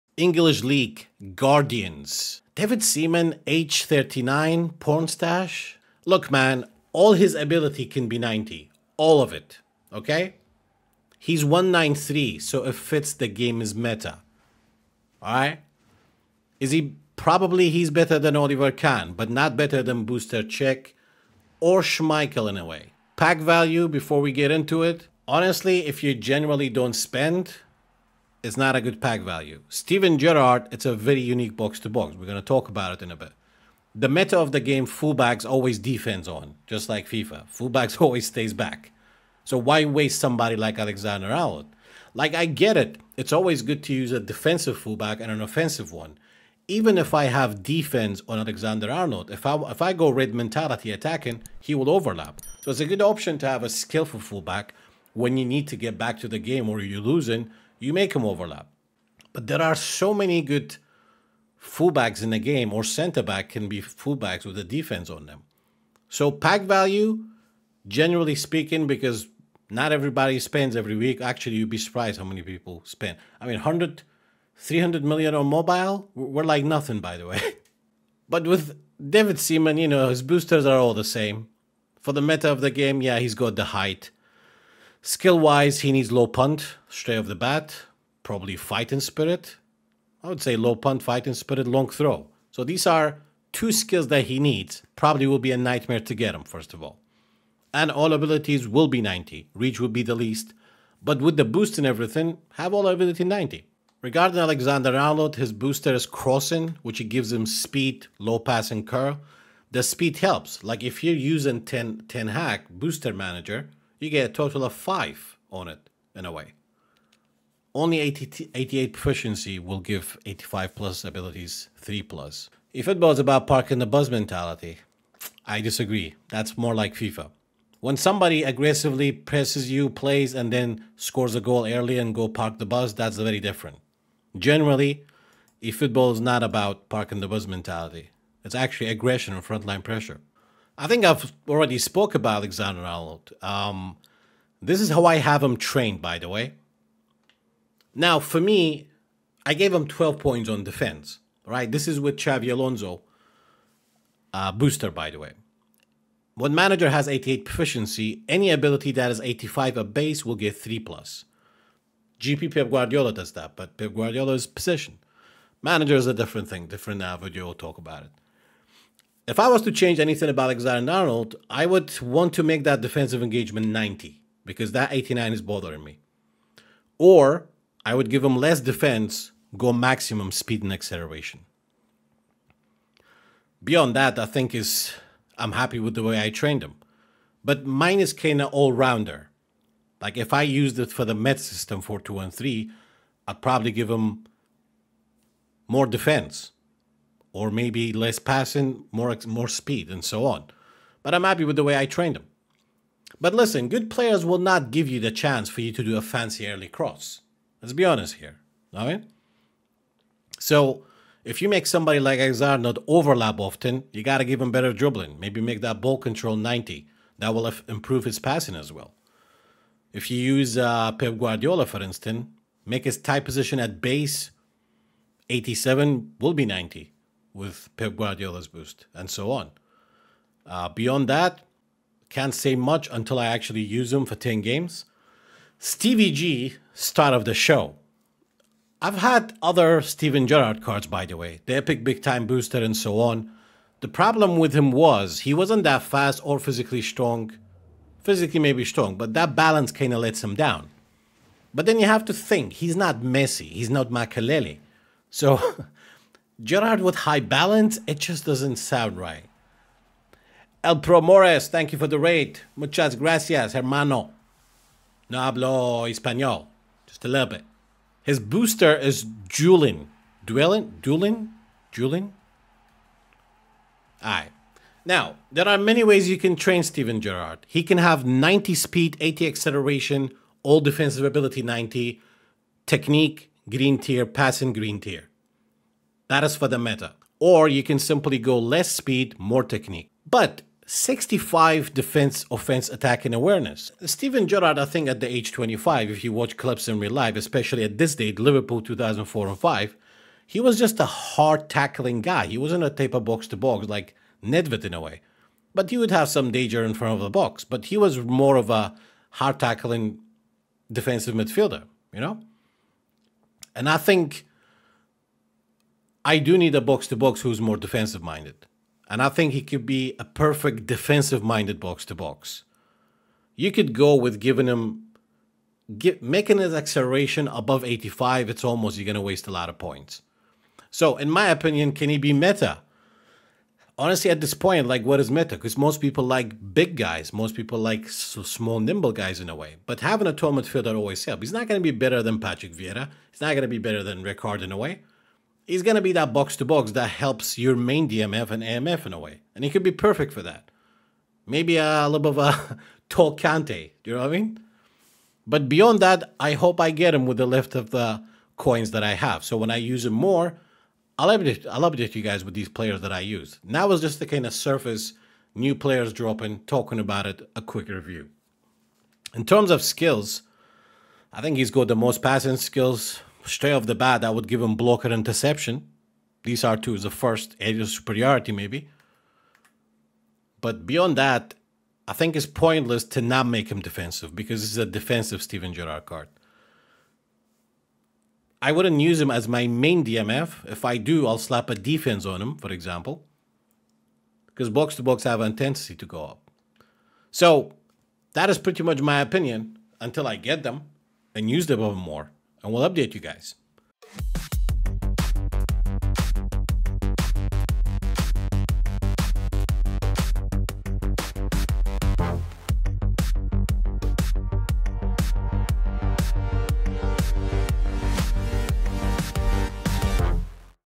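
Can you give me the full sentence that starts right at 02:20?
I think I've already spoke about Alexander Arnold.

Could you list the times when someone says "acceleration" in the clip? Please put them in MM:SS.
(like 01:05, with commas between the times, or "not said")
03:00, 04:39, 05:26.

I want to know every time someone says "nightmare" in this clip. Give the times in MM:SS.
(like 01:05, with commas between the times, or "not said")
01:35.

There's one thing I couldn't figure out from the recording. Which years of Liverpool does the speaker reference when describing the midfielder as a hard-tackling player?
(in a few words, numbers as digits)
2004 and 2005.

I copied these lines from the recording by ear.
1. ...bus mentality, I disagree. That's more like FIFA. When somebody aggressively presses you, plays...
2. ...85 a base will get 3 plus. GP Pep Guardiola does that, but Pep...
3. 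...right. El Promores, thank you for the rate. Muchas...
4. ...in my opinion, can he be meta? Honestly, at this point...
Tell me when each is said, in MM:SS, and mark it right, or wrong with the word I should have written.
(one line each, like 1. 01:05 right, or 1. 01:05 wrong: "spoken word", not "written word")
1. 02:03 right
2. 02:39 right
3. 04:18 right
4. 05:30 right.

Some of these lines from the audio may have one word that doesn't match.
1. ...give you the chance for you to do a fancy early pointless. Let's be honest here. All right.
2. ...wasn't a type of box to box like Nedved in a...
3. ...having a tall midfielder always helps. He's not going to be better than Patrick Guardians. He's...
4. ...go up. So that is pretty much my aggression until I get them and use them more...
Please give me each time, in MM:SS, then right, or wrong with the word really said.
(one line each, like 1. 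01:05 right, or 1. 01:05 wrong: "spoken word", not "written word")
1. 03:24 wrong: "cross", not "pointless"
2. 05:02 right
3. 05:39 wrong: "Vieira", not "Guardians"
4. 06:35 wrong: "opinion", not "aggression".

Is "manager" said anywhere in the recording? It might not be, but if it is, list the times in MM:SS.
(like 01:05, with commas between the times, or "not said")
01:53, 02:36, 02:45.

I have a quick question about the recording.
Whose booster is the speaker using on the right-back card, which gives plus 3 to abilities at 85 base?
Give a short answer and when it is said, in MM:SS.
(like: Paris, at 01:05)
Xabi Alonso, at 02:32.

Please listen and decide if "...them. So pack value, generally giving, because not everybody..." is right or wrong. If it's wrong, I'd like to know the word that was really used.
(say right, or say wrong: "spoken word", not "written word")
wrong: "speaking", not "giving".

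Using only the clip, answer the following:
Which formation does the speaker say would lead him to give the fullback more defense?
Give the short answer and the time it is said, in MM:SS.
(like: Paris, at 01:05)
4213, at 03:11.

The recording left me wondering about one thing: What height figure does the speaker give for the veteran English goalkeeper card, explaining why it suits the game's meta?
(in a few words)
193.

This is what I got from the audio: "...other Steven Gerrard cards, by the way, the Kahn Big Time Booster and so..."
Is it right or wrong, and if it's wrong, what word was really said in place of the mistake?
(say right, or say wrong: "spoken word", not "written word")
wrong: "Epic", not "Kahn".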